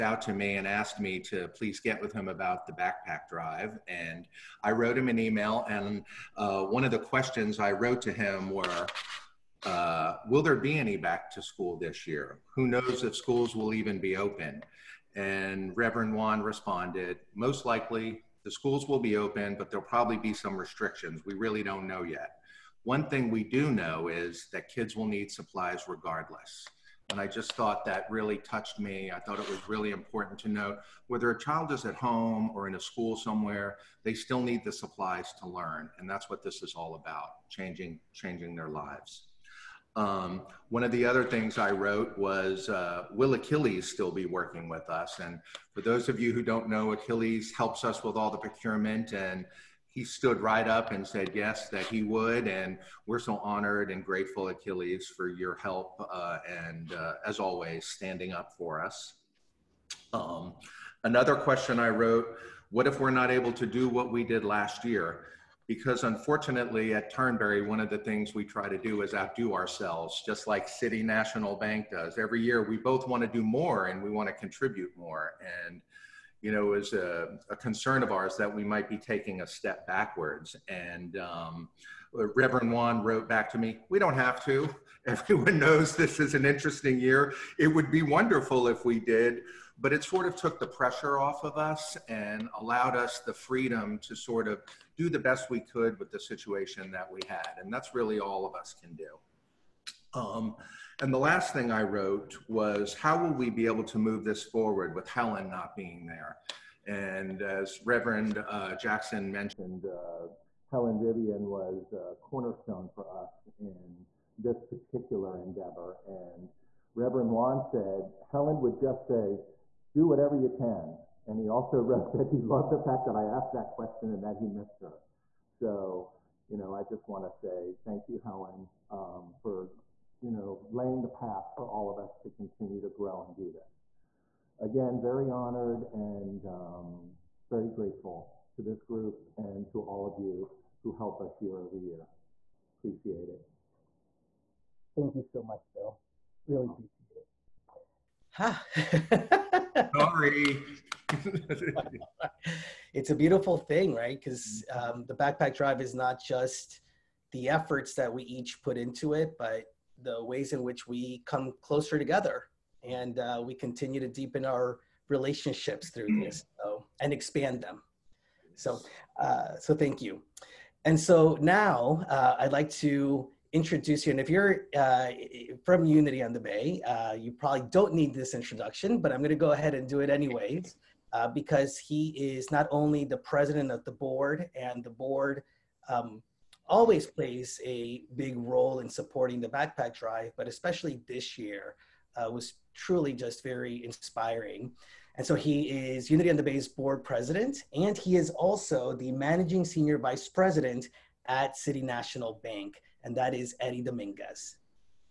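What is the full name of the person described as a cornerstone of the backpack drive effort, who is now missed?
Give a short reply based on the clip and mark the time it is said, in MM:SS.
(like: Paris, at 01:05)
Helen Vivian, at 01:50.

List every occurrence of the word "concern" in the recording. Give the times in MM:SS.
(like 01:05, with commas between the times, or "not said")
01:17.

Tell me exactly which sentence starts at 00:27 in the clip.
And I just thought that really touched me.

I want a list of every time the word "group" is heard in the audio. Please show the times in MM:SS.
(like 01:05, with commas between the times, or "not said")
02:18.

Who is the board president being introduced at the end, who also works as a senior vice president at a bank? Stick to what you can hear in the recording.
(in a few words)
Eddie Dominguez.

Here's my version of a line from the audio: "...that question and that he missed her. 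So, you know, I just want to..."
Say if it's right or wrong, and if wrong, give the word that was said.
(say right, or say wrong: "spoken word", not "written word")
right.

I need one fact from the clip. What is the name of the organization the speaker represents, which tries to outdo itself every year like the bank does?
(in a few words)
Turnberry.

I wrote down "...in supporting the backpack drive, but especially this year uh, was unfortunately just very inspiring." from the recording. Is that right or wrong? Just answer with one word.
wrong.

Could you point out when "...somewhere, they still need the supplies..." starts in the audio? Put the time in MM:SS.
00:33.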